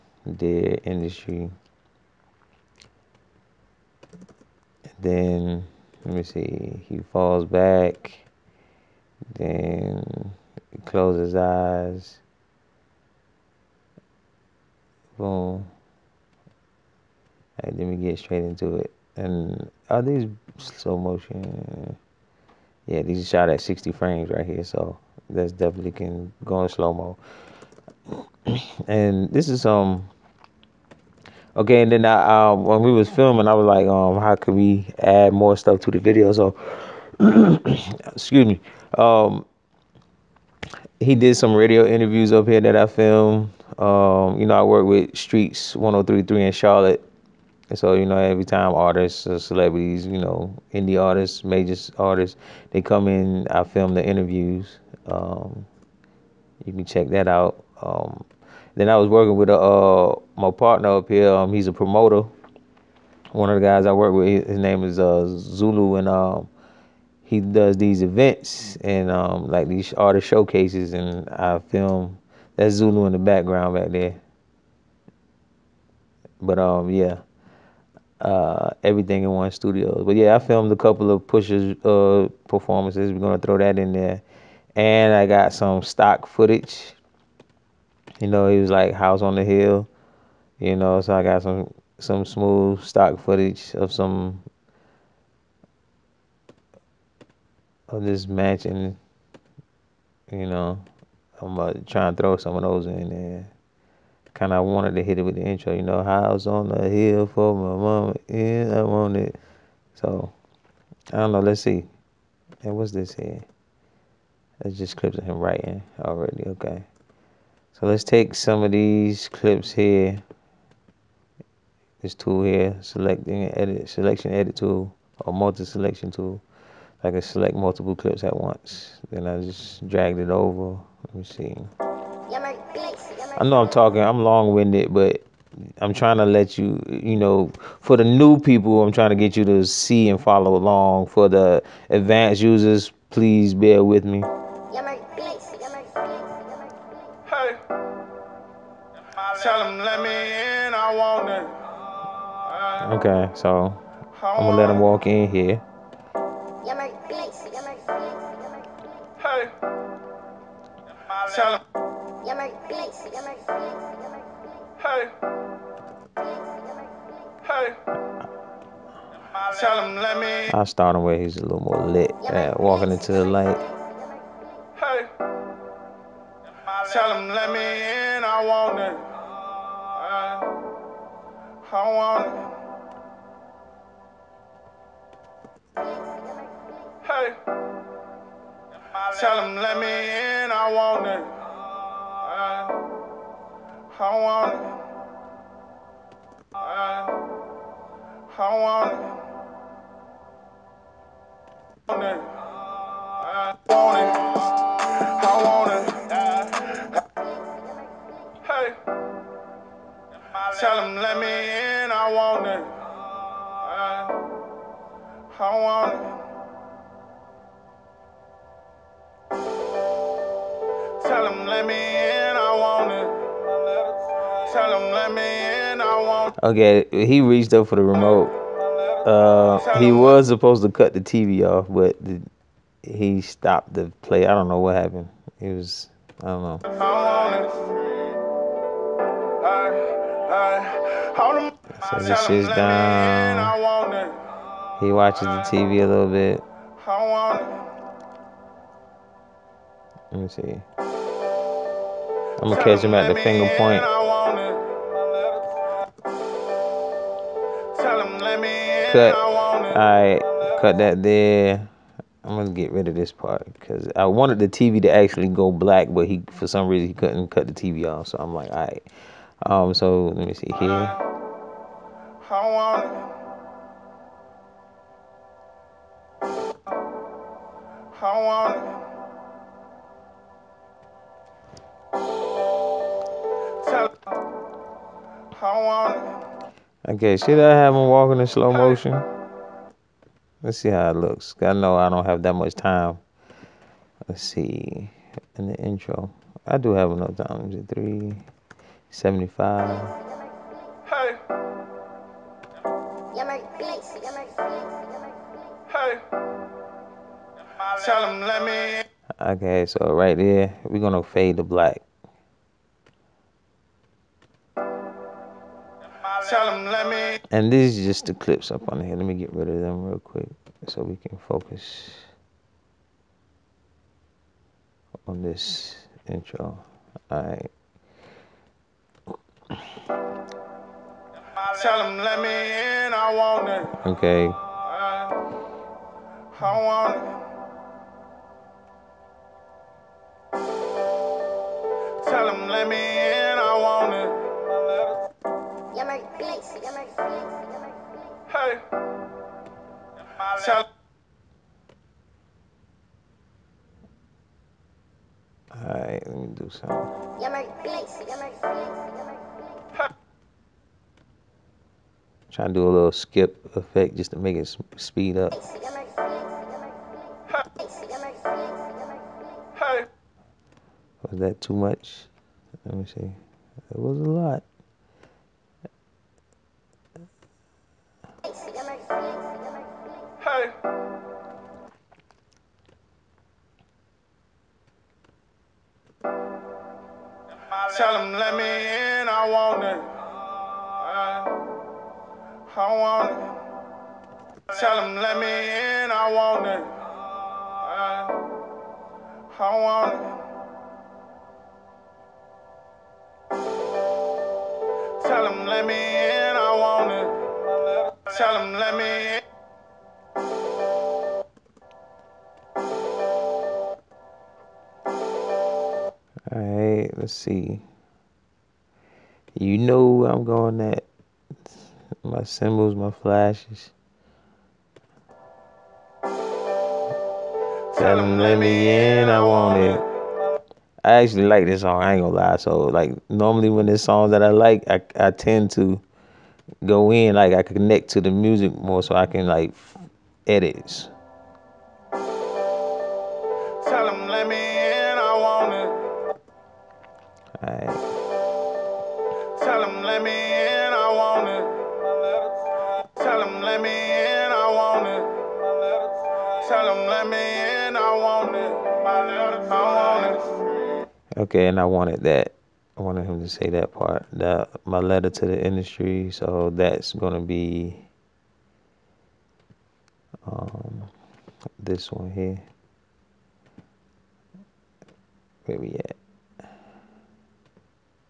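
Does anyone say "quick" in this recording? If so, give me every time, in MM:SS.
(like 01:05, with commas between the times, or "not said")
05:19.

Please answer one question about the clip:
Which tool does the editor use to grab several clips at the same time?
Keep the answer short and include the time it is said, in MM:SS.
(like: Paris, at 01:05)
multi-selection tool, at 02:05.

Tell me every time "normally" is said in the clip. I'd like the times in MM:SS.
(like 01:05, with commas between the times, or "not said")
07:13.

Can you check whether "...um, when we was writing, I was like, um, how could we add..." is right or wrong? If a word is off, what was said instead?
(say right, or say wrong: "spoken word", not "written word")
wrong: "filming", not "writing".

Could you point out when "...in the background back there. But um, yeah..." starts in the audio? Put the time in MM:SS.
01:13.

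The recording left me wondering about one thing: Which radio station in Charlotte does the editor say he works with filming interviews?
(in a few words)
Streets 1033.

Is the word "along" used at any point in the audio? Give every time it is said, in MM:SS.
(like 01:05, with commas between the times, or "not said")
02:20.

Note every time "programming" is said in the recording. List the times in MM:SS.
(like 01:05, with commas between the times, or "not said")
not said.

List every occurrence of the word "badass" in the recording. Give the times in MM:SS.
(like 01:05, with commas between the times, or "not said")
not said.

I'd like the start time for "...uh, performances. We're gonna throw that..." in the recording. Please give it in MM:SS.
01:21.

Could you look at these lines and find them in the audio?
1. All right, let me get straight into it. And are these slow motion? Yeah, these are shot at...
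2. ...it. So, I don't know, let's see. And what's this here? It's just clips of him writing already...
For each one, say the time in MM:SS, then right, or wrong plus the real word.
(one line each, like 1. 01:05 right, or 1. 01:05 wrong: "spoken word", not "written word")
1. 00:15 right
2. 01:49 right.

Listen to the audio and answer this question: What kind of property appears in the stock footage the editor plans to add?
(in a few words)
mansion.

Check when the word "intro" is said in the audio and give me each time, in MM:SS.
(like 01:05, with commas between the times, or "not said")
01:45, 04:55, 05:26.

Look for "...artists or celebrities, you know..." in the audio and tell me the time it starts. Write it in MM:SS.
00:48.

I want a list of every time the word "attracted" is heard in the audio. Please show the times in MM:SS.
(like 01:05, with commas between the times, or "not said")
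not said.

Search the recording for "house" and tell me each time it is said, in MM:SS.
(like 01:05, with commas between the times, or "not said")
01:28, 01:46.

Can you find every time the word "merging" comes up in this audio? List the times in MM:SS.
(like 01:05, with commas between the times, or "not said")
not said.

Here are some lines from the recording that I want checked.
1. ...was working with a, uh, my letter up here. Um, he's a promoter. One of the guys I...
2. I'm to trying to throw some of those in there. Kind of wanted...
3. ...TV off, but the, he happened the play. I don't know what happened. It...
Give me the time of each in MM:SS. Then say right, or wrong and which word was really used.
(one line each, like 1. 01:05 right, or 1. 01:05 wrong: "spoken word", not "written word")
1. 00:58 wrong: "partner", not "letter"
2. 01:41 right
3. 03:51 wrong: "stopped", not "happened".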